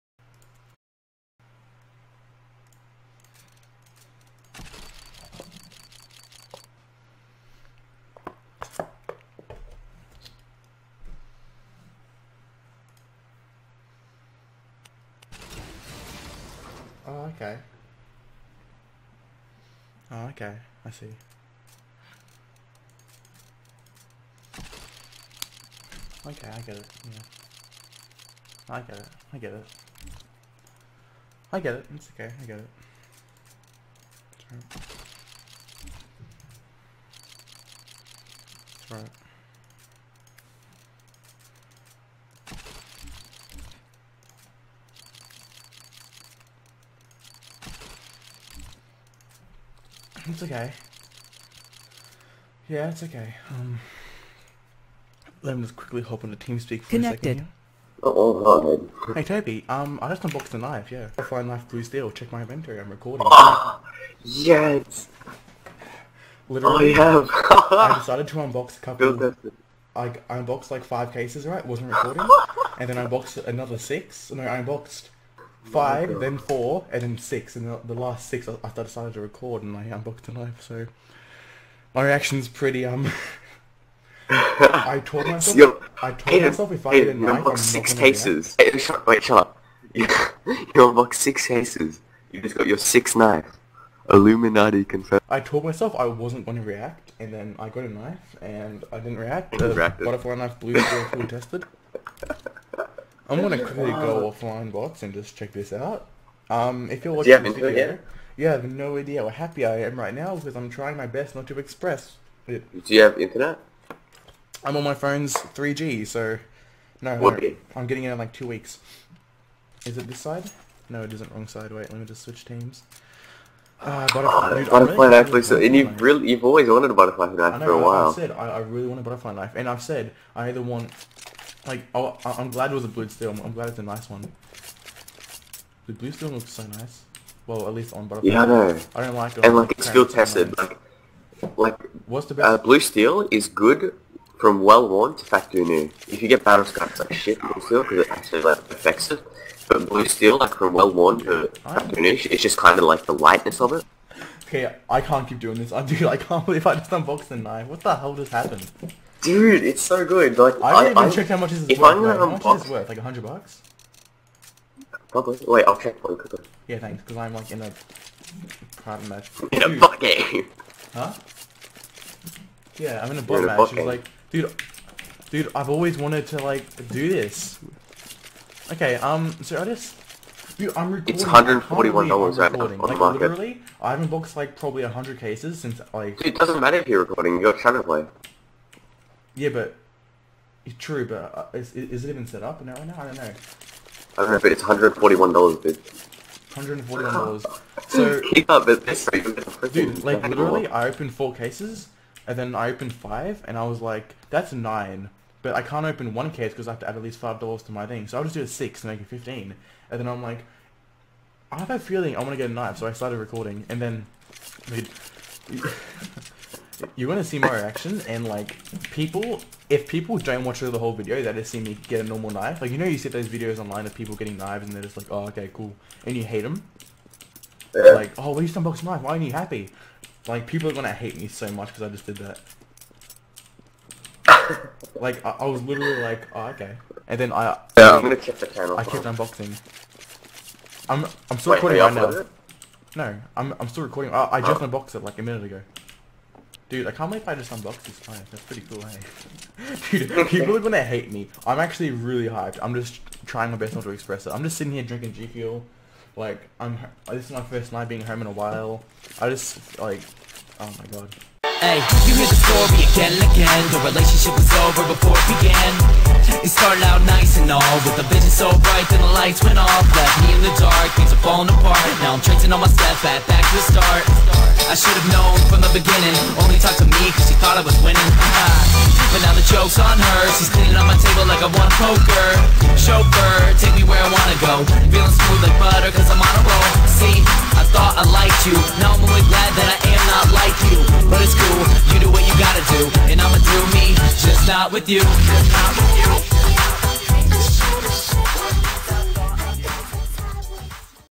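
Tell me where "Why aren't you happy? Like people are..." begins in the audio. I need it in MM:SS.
03:49.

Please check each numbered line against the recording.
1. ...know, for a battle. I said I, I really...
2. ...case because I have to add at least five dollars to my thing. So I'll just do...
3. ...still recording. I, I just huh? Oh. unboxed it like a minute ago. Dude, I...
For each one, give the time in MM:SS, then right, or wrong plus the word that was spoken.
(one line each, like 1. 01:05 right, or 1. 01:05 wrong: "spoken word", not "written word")
1. 02:07 wrong: "while", not "battle"
2. 03:26 right
3. 04:03 right.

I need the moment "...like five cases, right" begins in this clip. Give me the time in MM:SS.
01:10.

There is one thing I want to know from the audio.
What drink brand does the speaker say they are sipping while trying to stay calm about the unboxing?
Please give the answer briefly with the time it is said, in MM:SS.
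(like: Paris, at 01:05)
G Fuel, at 04:15.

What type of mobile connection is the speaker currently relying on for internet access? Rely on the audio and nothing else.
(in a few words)
3G.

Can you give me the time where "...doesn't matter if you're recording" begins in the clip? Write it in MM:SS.
03:06.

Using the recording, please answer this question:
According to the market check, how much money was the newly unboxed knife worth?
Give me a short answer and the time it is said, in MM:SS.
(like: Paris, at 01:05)
$141, at 03:01.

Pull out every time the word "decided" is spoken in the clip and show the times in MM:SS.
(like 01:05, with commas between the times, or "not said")
01:07, 01:18.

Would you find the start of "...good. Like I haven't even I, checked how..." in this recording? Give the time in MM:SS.
02:40.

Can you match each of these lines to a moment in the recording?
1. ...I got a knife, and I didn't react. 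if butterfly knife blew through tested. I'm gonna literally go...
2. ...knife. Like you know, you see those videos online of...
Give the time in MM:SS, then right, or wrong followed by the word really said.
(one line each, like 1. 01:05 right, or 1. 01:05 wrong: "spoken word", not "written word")
1. 01:37 wrong: "quickly", not "literally"
2. 03:42 right.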